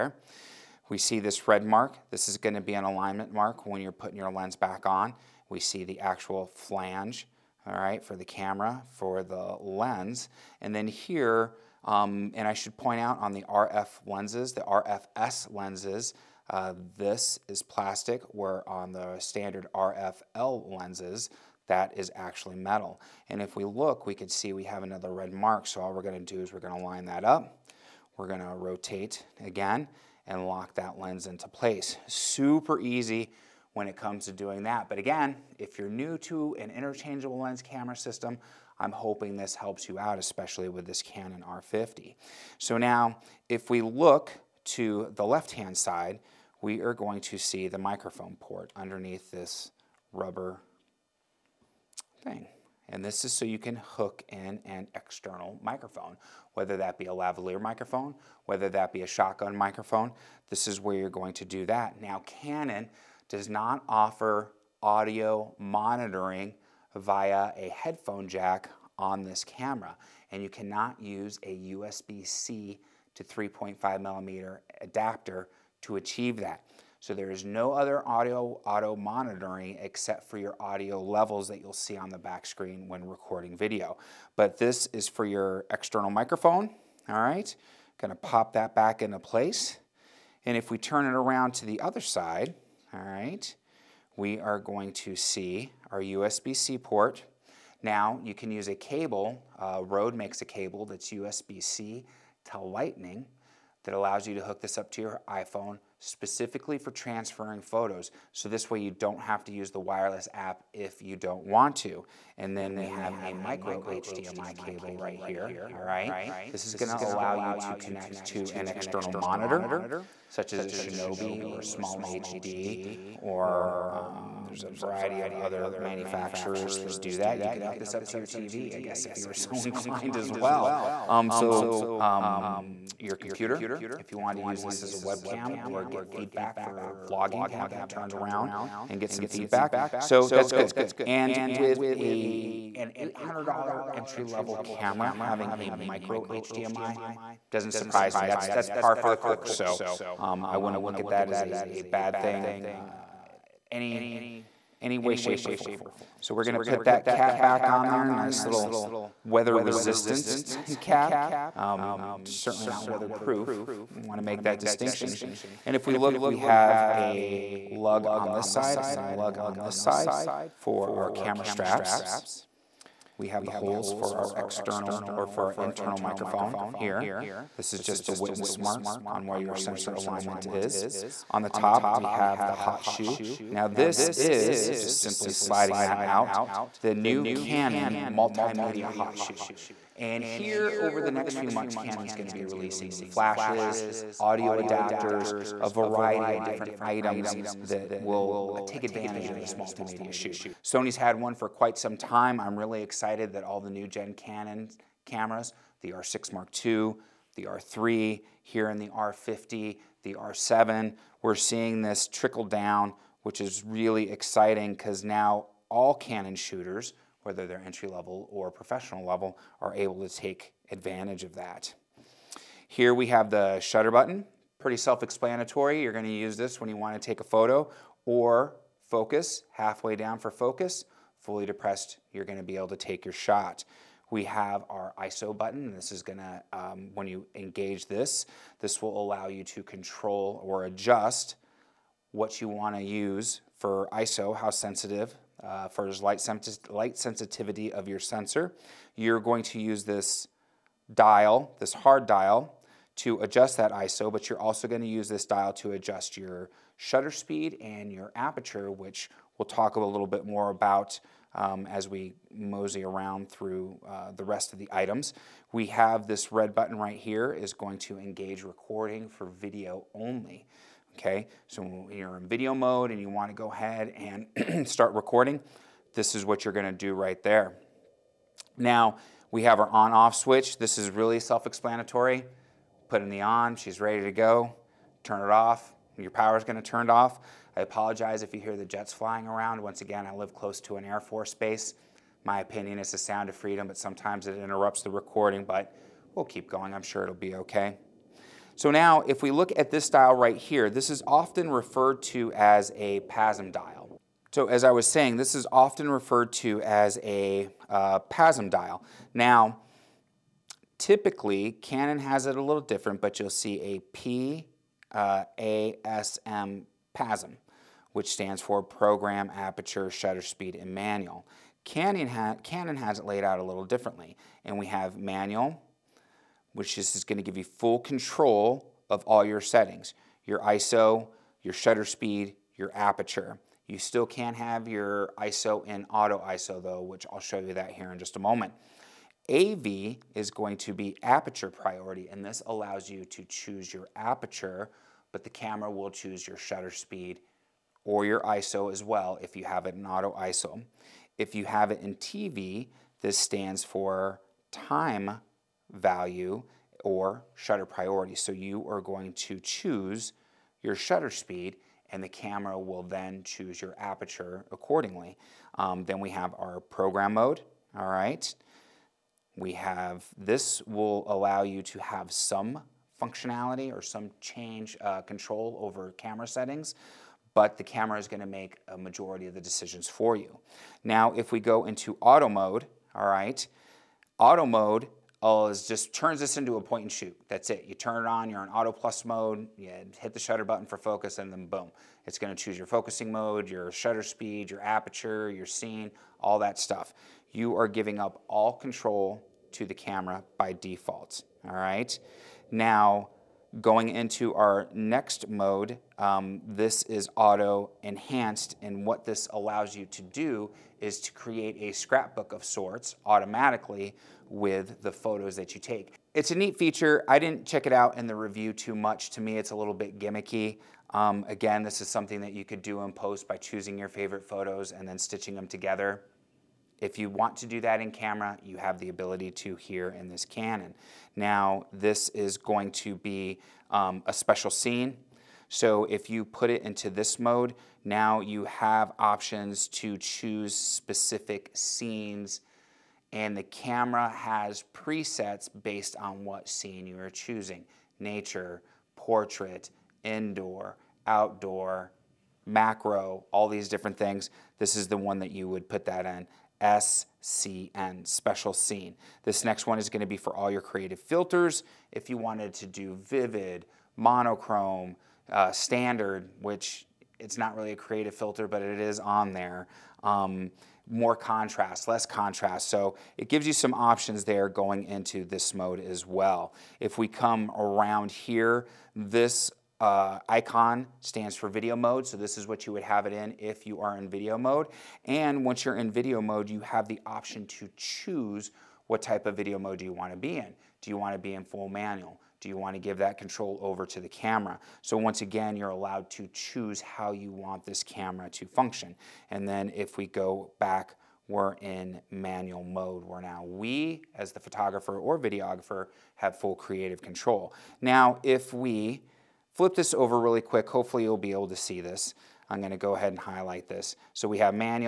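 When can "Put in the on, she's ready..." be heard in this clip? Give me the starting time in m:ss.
4:42.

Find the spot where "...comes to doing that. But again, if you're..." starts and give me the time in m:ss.
0:33.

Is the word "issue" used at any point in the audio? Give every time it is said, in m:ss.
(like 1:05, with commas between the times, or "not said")
not said.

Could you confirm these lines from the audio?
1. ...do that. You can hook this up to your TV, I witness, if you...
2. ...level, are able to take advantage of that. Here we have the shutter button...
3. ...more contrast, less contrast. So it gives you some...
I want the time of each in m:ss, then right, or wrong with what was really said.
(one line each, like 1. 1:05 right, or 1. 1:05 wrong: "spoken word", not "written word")
1. 2:06 wrong: "guess", not "witness"
2. 3:39 right
3. 7:50 right.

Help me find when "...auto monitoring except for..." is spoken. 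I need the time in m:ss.
1:18.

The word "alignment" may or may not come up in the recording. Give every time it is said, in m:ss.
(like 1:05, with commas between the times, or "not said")
0:02, 2:59.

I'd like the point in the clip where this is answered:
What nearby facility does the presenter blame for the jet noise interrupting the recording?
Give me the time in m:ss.
4:50.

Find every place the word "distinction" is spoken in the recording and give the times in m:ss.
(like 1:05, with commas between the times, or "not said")
2:44.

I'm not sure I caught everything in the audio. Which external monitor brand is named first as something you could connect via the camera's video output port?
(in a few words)
Shinobi.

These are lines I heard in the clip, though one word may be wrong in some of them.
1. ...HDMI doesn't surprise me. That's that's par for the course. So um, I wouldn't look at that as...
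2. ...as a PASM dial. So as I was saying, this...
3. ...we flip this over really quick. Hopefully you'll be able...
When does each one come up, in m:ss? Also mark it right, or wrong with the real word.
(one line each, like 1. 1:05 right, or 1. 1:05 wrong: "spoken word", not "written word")
1. 2:26 right
2. 5:02 right
3. 8:28 right.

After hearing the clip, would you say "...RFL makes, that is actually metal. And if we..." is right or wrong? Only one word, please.
wrong.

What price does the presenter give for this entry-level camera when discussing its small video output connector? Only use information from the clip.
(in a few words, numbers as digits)
$800.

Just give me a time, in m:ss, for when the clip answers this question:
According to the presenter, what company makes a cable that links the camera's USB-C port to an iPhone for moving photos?
1:39.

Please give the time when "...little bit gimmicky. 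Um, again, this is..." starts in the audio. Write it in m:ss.
6:59.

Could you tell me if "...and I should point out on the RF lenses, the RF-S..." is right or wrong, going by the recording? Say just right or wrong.
right.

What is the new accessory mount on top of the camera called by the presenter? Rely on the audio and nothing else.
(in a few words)
multimedia hot shoe.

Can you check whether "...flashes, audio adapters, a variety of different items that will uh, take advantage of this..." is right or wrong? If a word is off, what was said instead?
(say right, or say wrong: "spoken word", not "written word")
right.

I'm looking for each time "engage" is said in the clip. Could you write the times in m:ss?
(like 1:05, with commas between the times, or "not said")
3:57, 4:27.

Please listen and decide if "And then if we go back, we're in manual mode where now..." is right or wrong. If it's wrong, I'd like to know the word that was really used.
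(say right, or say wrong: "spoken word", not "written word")
right.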